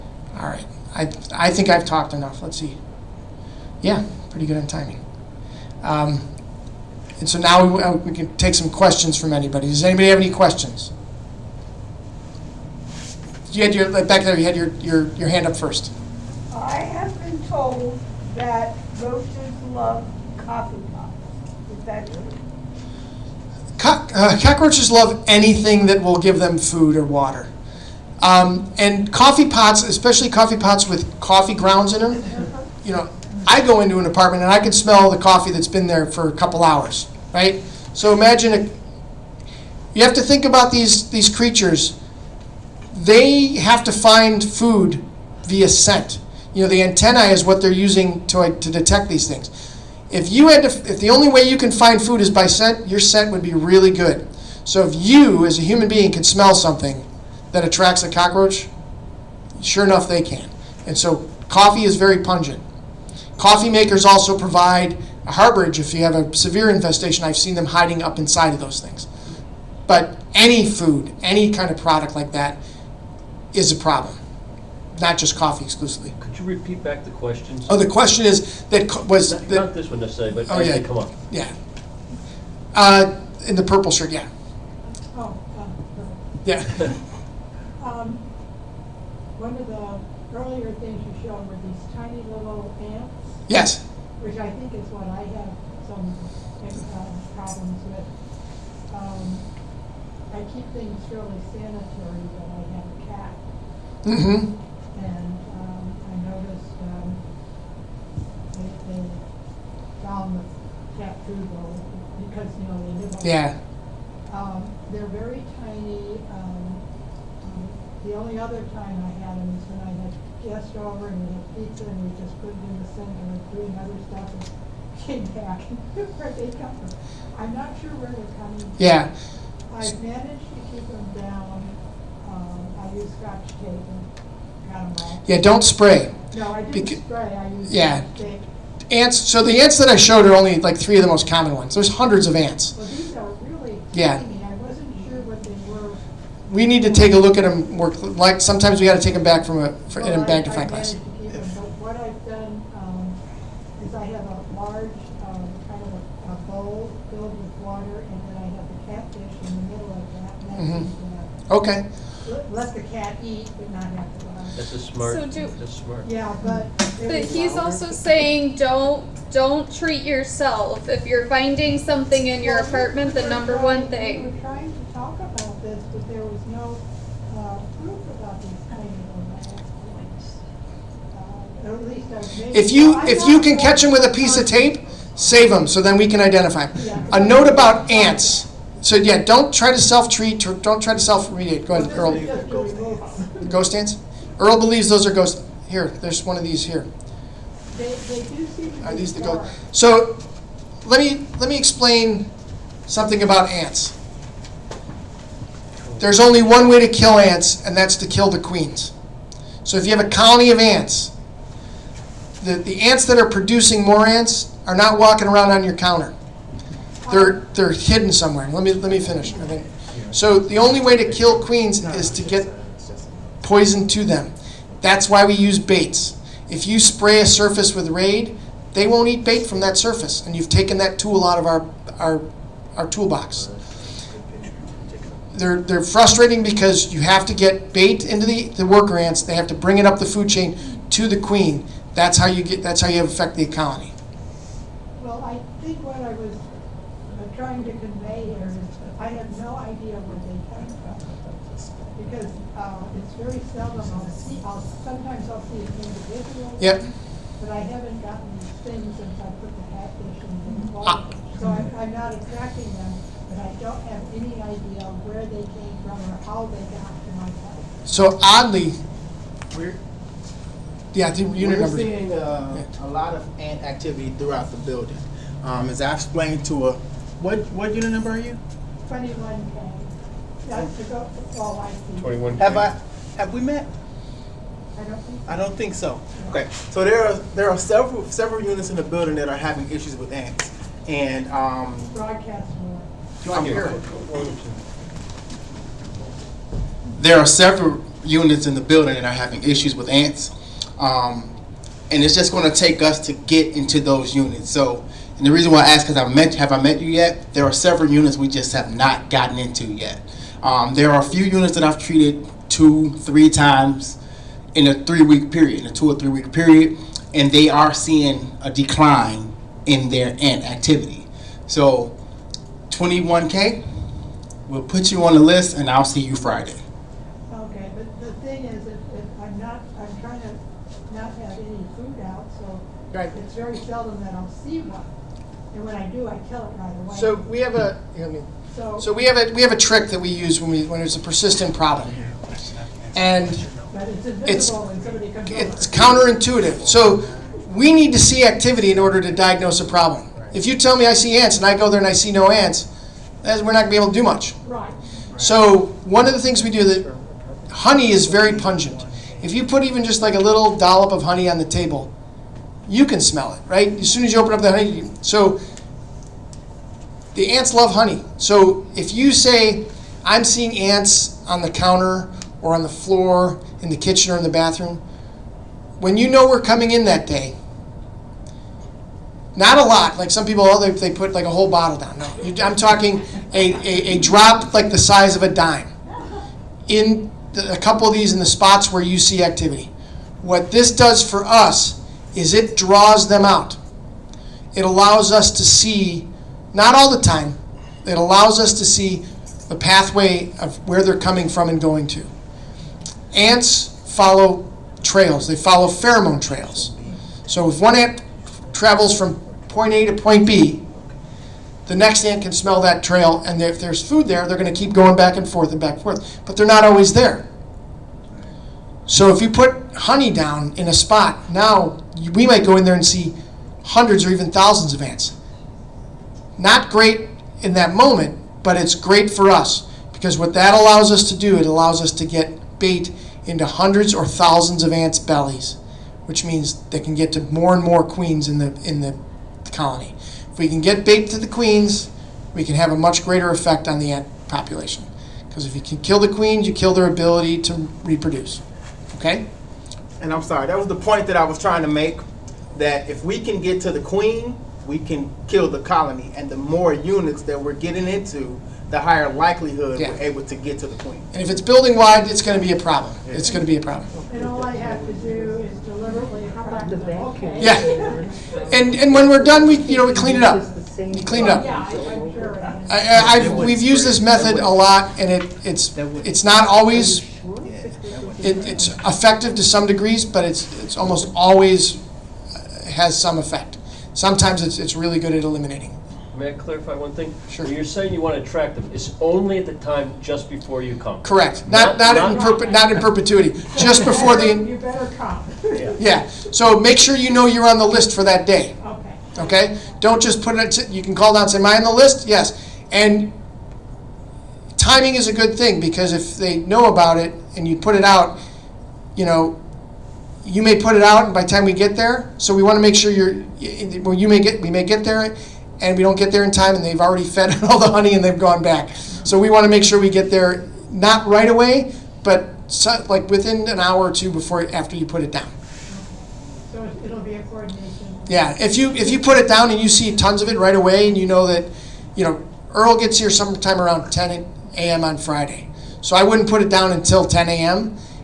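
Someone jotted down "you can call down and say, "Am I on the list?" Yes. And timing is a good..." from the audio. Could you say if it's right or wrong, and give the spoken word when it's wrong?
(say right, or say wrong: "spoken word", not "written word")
right.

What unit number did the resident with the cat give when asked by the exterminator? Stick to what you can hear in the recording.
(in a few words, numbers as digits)
21K.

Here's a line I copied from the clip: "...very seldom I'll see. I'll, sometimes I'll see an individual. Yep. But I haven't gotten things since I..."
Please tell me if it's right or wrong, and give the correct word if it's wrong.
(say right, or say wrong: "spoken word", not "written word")
right.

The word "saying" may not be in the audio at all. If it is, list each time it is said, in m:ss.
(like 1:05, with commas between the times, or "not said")
2:47, 8:07.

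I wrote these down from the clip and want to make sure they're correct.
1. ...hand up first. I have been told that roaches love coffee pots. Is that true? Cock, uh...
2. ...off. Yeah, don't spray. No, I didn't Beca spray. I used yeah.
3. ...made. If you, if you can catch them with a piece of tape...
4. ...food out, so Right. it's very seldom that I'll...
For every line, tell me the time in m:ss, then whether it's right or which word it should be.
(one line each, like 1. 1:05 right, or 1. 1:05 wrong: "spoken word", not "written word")
1. 0:15 right
2. 2:15 right
3. 3:02 right
4. 5:31 right.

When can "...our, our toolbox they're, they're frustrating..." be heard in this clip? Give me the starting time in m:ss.
3:51.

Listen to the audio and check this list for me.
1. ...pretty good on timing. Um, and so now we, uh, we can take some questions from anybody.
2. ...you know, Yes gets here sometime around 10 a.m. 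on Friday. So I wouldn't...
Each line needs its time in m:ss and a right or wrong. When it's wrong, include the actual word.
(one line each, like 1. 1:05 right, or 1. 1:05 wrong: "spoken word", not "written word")
1. 0:04 right
2. 8:51 wrong: "Earl", not "Yes".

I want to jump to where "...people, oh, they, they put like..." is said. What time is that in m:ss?
6:20.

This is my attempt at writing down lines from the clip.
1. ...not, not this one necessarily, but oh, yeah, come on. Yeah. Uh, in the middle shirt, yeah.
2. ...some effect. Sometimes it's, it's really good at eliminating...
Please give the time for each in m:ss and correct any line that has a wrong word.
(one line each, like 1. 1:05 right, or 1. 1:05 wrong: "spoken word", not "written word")
1. 1:19 wrong: "purple", not "middle"
2. 8:03 right.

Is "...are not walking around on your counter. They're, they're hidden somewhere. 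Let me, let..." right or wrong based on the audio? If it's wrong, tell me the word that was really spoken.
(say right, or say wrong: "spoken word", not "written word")
right.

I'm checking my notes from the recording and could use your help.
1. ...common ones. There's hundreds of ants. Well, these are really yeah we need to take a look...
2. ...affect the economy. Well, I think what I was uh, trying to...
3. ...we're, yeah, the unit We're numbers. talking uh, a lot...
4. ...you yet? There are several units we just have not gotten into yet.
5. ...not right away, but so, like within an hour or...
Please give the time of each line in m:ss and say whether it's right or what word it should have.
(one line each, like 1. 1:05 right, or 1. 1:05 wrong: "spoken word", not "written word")
1. 2:21 right
2. 4:03 right
3. 4:29 wrong: "seeing", not "talking"
4. 5:06 right
5. 8:40 right.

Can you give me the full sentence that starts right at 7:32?
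That if we can get to the queen, we can kill the colony.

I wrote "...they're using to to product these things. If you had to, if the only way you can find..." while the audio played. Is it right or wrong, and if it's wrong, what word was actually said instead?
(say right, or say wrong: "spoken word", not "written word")
wrong: "detect", not "product".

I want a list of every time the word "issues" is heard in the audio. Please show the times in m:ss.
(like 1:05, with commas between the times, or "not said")
4:49, 4:59.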